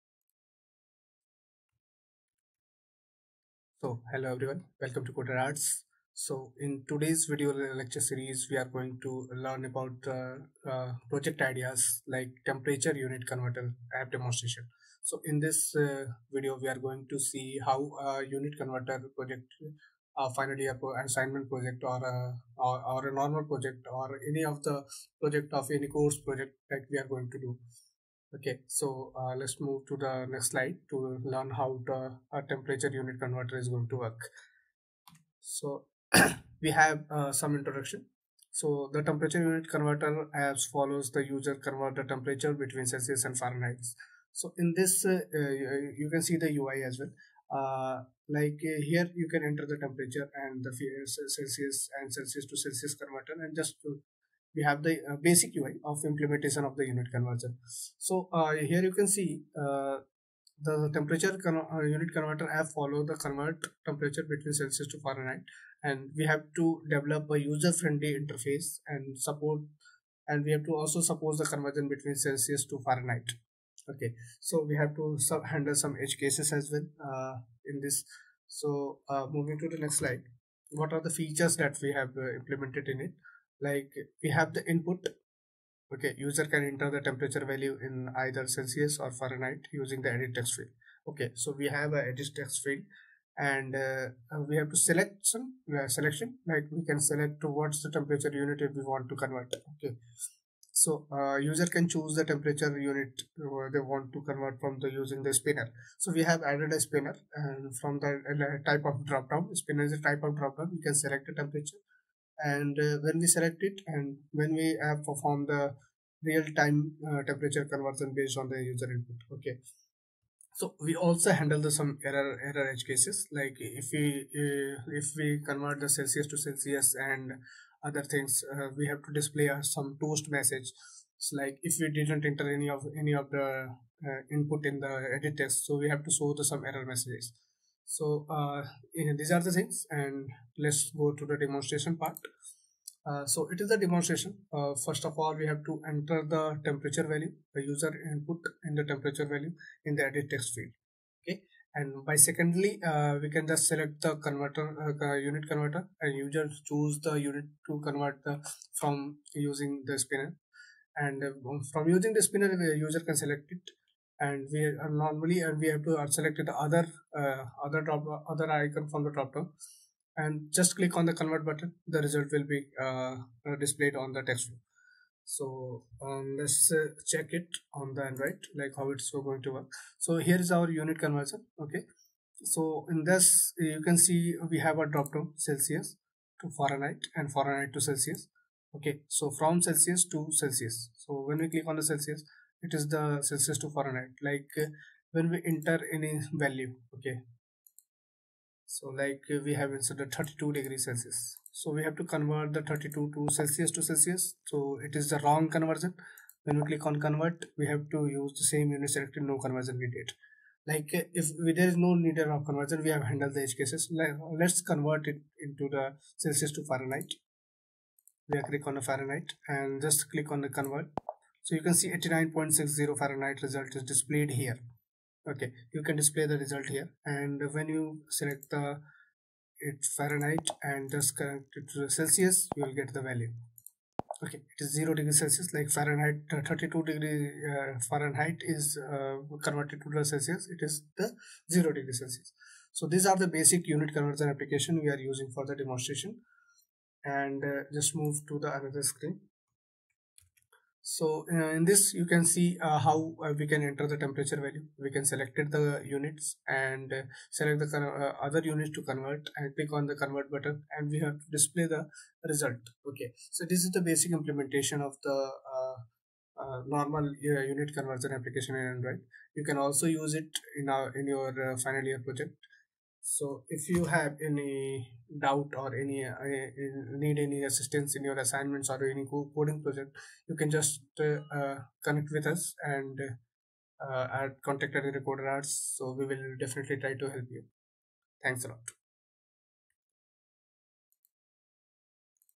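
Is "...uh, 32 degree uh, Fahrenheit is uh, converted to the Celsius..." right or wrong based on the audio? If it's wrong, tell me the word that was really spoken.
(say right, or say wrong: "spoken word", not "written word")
right.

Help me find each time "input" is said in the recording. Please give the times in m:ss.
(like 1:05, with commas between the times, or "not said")
1:24, 1:58, 2:14, 2:28.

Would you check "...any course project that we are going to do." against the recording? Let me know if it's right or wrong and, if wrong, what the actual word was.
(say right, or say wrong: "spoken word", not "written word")
right.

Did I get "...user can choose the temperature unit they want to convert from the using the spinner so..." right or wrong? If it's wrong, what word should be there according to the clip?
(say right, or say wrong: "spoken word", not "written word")
right.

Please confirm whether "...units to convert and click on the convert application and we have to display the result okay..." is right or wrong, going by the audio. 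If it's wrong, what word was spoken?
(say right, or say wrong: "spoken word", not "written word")
wrong: "button", not "application".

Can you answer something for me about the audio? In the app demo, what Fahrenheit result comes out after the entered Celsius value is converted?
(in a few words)
89.60 Fahrenheit.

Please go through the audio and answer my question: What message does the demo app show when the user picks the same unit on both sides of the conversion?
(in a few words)
Same unit selected, no conversion needed.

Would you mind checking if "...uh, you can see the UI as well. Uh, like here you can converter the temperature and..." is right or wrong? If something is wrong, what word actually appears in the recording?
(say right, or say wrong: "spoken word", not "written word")
wrong: "enter", not "converter".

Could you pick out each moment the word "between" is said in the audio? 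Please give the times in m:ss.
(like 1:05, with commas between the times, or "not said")
0:42, 1:04, 1:11.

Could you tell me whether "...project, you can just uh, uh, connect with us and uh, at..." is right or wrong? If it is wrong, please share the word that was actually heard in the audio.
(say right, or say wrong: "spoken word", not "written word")
right.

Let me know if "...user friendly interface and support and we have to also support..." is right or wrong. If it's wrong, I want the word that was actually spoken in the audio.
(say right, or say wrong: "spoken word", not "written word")
right.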